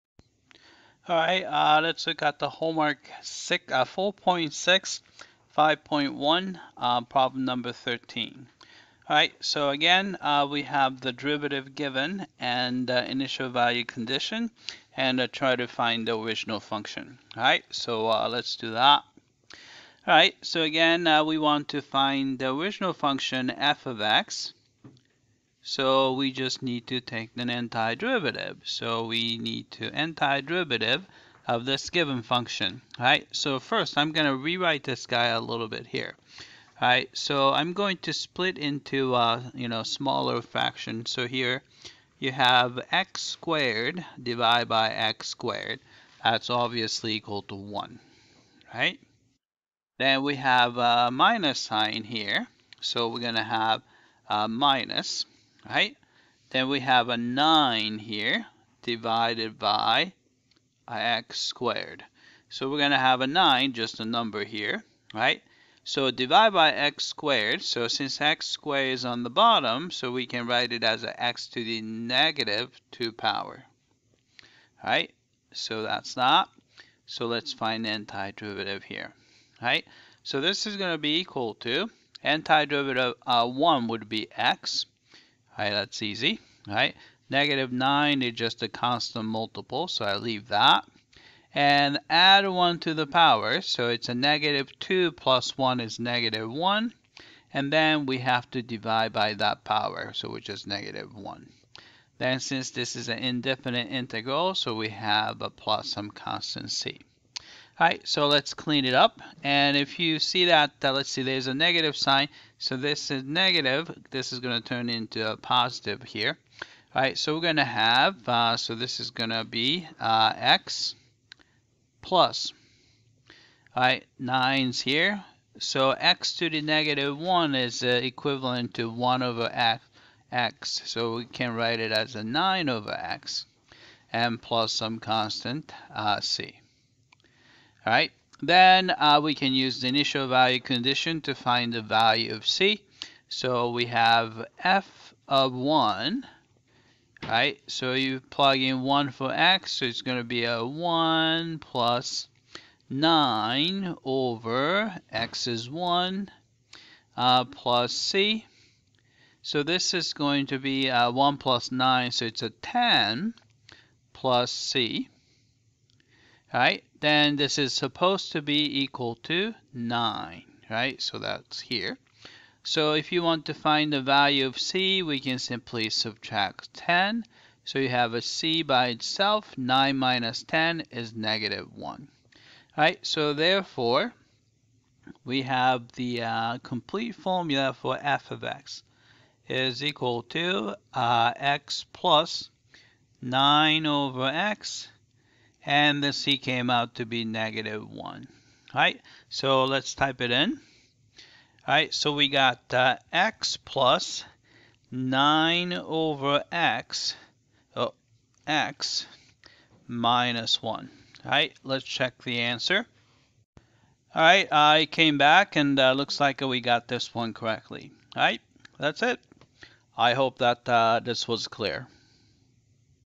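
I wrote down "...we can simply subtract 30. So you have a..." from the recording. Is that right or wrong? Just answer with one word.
wrong.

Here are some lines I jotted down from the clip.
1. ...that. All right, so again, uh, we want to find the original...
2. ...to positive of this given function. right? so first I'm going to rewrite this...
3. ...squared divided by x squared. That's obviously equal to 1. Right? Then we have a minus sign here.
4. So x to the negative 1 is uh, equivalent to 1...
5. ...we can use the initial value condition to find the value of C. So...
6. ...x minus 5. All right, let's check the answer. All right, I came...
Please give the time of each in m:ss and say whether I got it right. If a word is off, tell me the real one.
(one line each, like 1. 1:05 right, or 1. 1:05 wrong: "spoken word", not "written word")
1. 0:18 right
2. 0:29 wrong: "antiderivative", not "positive"
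3. 0:43 right
4. 2:05 right
5. 2:19 right
6. 3:28 wrong: "1", not "5".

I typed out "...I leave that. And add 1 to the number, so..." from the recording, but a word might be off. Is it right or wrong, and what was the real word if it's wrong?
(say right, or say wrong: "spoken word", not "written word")
wrong: "power", not "number".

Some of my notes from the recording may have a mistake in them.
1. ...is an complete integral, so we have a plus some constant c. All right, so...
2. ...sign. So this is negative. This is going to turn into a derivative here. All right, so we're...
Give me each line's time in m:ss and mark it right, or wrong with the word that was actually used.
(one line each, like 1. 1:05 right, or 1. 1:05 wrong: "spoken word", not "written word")
1. 1:42 wrong: "indefinite", not "complete"
2. 1:51 wrong: "positive", not "derivative".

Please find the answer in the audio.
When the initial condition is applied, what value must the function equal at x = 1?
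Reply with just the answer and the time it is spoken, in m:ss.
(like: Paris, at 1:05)
9, at 2:48.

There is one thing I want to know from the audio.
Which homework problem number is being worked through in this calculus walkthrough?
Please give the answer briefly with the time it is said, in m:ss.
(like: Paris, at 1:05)
13, at 0:07.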